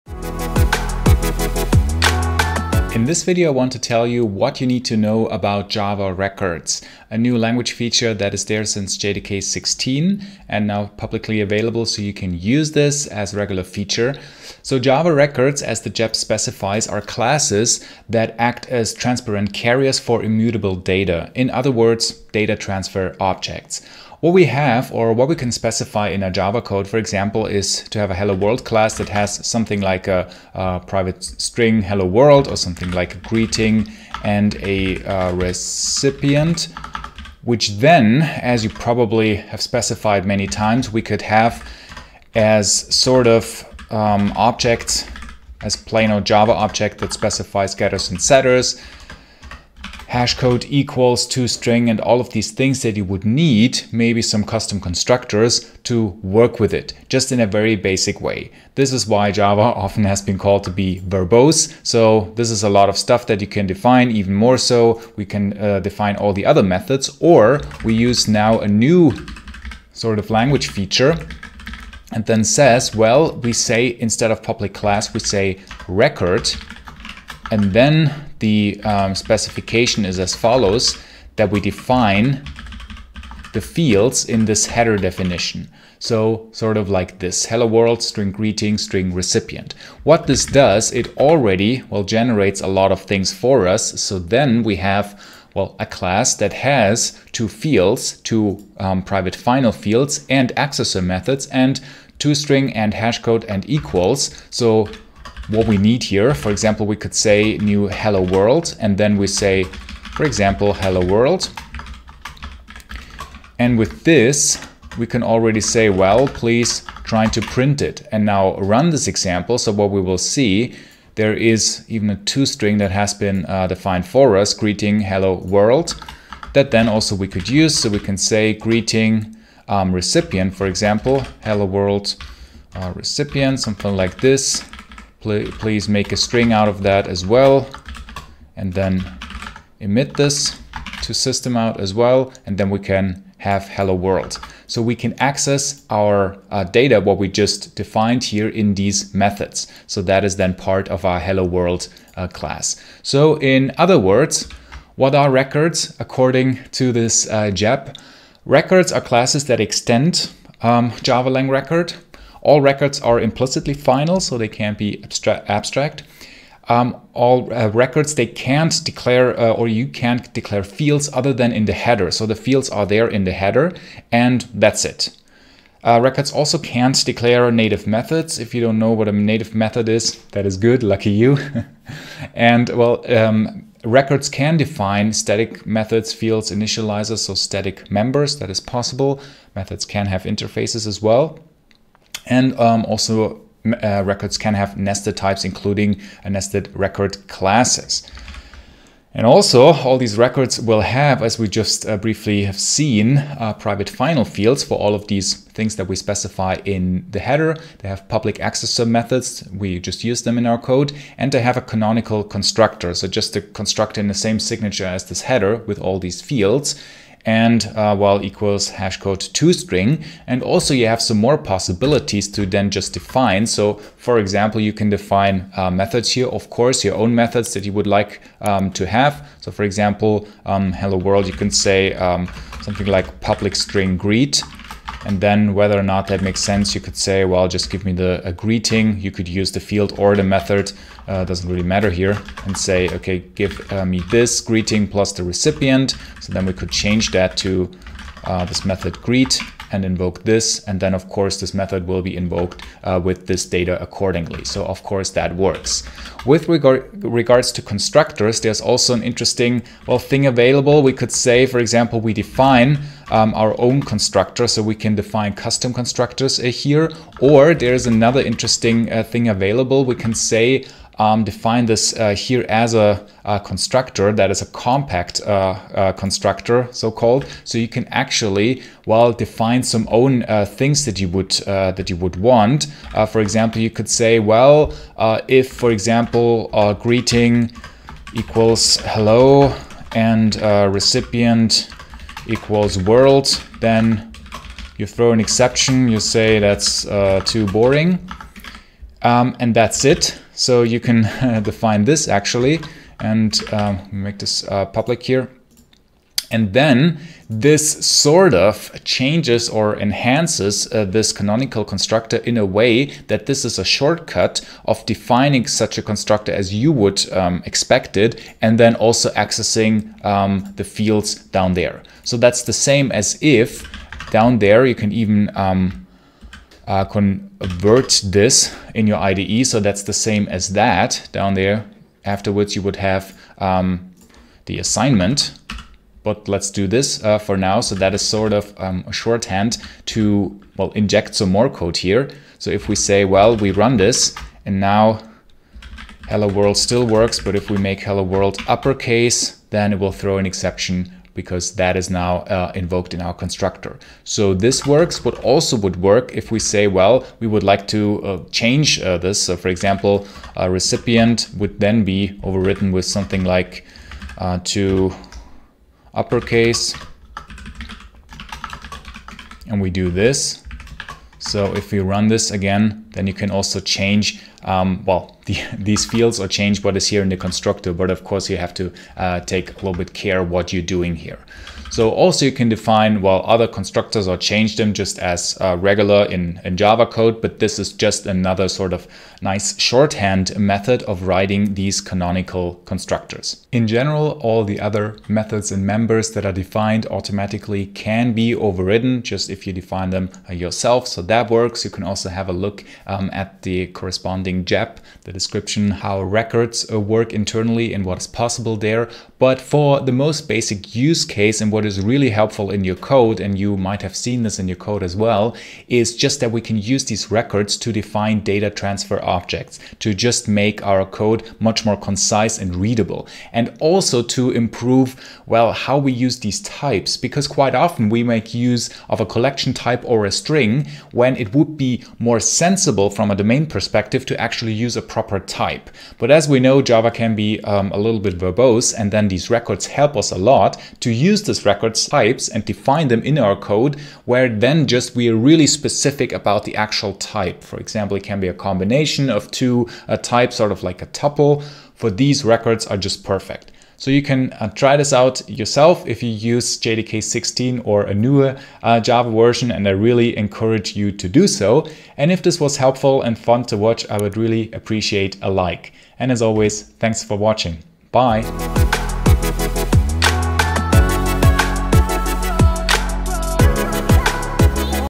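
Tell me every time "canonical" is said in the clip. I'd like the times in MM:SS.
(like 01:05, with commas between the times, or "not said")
03:31, 05:11, 06:31.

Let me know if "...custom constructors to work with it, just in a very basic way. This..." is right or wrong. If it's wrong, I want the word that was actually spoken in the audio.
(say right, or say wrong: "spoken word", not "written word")
right.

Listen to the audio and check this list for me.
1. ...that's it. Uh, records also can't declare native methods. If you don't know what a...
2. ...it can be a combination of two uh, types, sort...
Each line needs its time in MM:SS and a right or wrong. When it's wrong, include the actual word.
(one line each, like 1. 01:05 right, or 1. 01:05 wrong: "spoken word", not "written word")
1. 02:54 right
2. 07:27 right.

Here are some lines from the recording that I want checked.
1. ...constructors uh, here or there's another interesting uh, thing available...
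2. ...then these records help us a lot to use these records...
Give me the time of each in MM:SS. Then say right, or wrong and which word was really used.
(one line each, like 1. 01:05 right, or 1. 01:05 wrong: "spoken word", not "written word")
1. 04:25 right
2. 07:18 right.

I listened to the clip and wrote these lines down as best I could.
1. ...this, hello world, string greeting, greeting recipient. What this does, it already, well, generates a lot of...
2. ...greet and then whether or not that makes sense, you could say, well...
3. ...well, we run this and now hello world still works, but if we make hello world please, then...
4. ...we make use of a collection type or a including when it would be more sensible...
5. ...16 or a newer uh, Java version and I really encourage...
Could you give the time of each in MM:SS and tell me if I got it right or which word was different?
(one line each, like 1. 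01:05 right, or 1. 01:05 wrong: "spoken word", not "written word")
1. 01:27 wrong: "string", not "greeting"
2. 03:53 right
3. 05:43 wrong: "uppercase", not "please"
4. 07:07 wrong: "string", not "including"
5. 07:37 right.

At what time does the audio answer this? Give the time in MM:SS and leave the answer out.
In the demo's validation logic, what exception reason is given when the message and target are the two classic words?
04:57.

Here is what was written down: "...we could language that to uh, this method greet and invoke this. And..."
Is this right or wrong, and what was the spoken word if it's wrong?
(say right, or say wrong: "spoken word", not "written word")
wrong: "change", not "language".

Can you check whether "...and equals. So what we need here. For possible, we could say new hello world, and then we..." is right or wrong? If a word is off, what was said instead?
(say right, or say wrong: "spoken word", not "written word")
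wrong: "example", not "possible".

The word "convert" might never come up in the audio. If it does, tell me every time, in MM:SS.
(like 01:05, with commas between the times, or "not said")
05:26.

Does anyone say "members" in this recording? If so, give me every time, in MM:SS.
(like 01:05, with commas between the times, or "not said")
03:07, 06:35.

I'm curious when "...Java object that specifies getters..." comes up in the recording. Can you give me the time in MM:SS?
00:46.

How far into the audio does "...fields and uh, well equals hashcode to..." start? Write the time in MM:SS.
03:36.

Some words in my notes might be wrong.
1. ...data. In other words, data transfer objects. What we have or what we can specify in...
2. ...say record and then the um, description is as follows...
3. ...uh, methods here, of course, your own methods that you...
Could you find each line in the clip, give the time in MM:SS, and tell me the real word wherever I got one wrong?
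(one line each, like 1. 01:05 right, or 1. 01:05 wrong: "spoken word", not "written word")
1. 00:20 right
2. 01:15 wrong: "specification", not "description"
3. 03:45 right.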